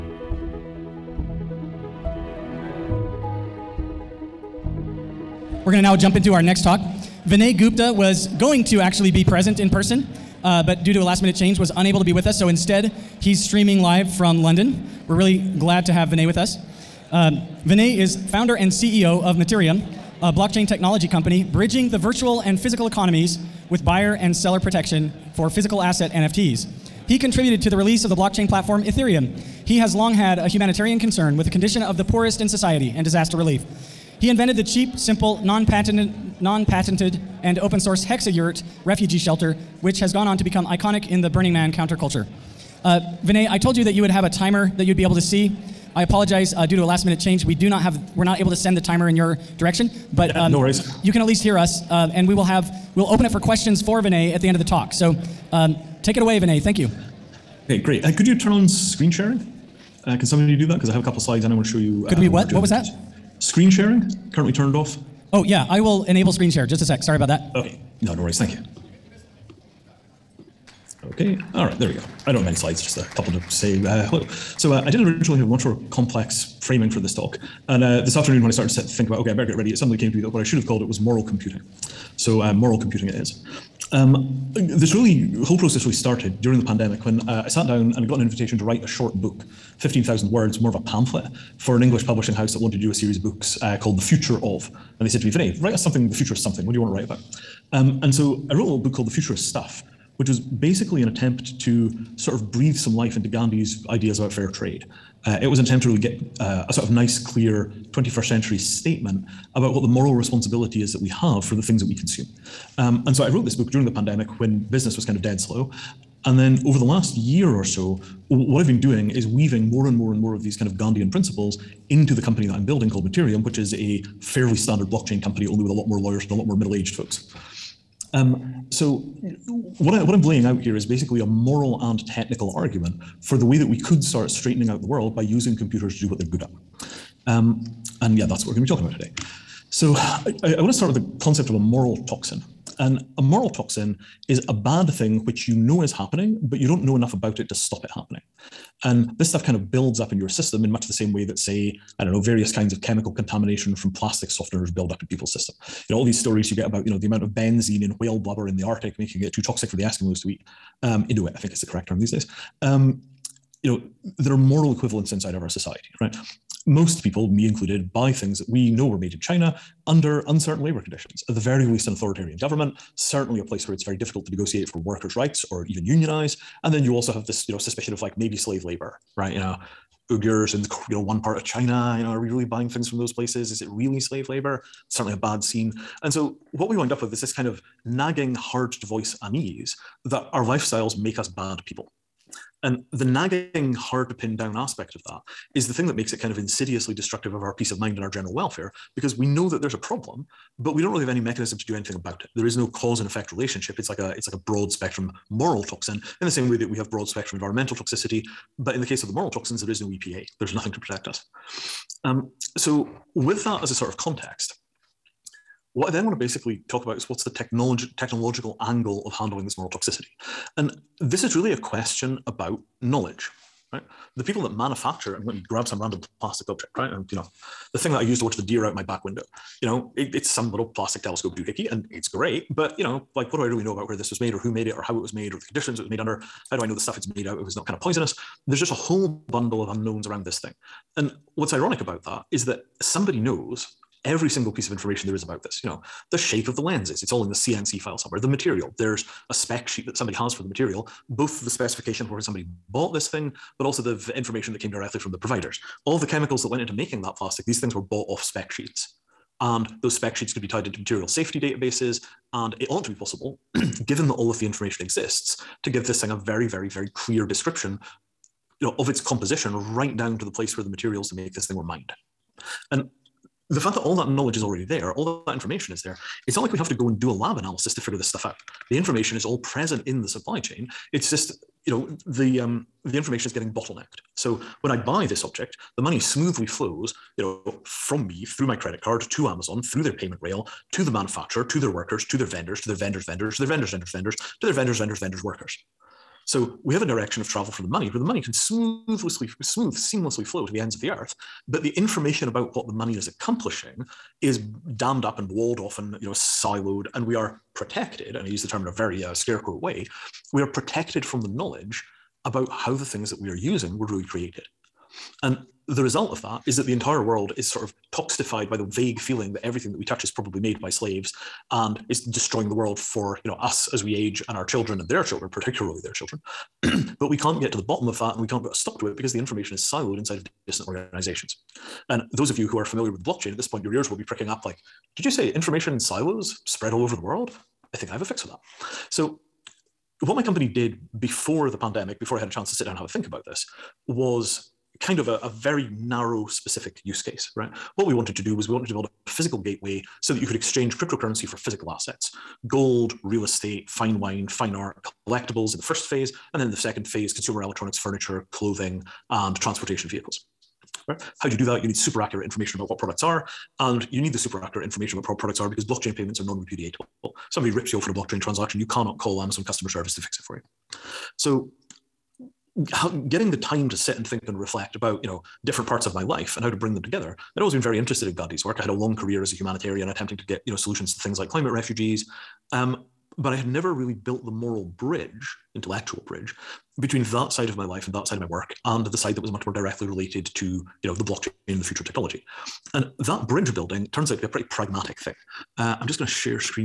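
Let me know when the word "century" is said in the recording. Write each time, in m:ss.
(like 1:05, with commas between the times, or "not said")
1:48.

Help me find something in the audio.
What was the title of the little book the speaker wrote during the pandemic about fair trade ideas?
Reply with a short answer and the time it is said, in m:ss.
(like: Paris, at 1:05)
The Future of Stuff, at 1:39.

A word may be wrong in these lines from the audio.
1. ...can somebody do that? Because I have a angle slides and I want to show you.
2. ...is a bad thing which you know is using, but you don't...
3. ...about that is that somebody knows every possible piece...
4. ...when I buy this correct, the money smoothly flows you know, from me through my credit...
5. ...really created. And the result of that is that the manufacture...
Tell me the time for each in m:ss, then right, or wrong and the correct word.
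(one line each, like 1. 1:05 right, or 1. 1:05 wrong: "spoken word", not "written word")
1. 1:00 wrong: "couple", not "angle"
2. 2:24 wrong: "happening", not "using"
3. 4:01 wrong: "single", not "possible"
4. 4:44 wrong: "object", not "correct"
5. 5:13 wrong: "entire", not "manufacture".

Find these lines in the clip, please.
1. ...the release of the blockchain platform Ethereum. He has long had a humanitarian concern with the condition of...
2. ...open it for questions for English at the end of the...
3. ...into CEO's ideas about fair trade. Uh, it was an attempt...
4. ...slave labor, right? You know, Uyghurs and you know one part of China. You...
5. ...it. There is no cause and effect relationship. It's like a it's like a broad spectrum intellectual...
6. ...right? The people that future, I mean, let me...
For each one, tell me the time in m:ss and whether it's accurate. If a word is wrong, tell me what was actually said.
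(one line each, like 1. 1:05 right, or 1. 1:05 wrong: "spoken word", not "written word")
1. 0:27 right
2. 0:53 wrong: "Vinay", not "English"
3. 1:43 wrong: "Gandhi", not "CEO"
4. 2:58 right
5. 3:22 wrong: "moral", not "intellectual"
6. 3:43 wrong: "manufacture", not "future".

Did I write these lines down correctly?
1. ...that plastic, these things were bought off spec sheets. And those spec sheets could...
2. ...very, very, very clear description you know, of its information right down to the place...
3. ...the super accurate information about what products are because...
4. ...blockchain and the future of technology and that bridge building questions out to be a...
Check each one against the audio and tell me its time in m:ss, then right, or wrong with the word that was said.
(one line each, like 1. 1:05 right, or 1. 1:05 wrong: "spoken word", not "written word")
1. 4:17 right
2. 4:26 wrong: "composition", not "information"
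3. 6:04 right
4. 6:31 wrong: "turns", not "questions".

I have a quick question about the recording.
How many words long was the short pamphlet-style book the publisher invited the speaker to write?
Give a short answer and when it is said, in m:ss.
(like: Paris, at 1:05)
15,000, at 1:29.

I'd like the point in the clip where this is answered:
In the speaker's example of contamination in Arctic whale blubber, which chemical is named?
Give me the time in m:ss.
2:37.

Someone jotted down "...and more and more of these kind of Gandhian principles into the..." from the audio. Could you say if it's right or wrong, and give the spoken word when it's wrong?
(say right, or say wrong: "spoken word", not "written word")
right.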